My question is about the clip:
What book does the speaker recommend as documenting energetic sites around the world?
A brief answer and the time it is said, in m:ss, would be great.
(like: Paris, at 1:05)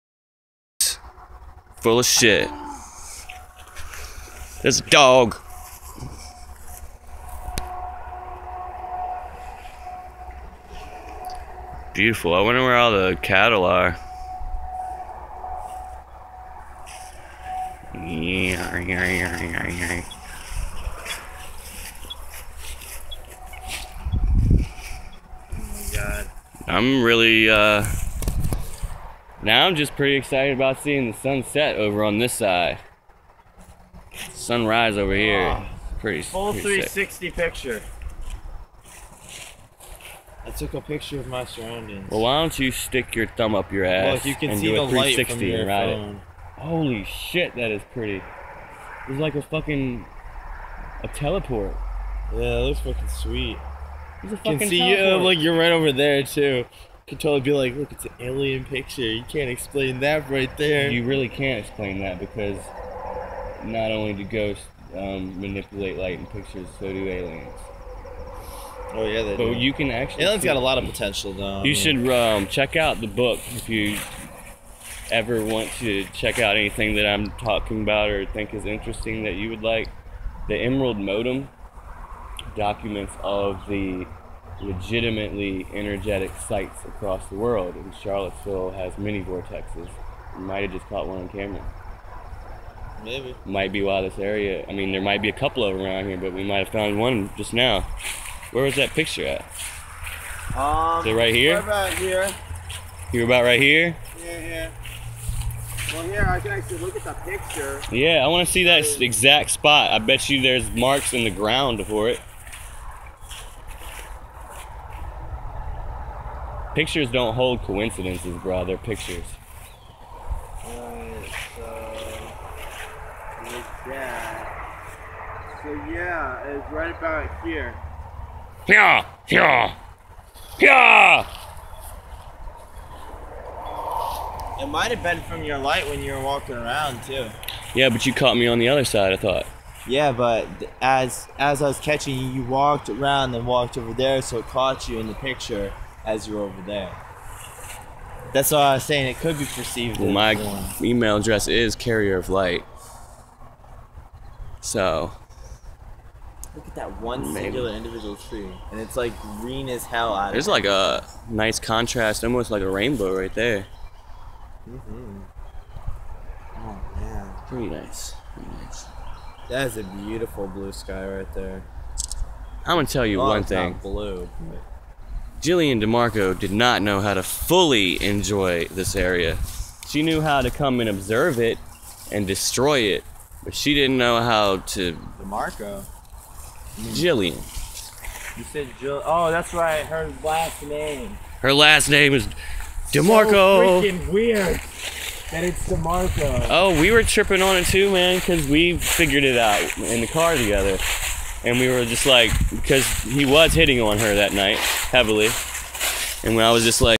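The Emerald Modem, at 1:20.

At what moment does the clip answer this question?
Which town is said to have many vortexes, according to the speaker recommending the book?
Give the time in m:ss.
1:28.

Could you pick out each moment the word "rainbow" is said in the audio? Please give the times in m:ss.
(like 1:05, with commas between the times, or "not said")
2:42.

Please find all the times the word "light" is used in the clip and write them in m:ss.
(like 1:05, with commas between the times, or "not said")
0:44, 1:05, 2:15, 2:32.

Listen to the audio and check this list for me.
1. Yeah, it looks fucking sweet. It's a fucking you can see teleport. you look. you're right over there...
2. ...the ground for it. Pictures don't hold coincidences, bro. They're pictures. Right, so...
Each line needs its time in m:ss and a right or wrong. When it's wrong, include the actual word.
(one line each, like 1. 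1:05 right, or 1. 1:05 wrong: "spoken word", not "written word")
1. 0:52 right
2. 1:51 right.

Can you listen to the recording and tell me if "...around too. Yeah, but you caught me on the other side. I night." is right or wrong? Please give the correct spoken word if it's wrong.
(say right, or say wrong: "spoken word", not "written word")
wrong: "thought", not "night".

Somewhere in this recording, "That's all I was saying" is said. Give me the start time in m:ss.
2:28.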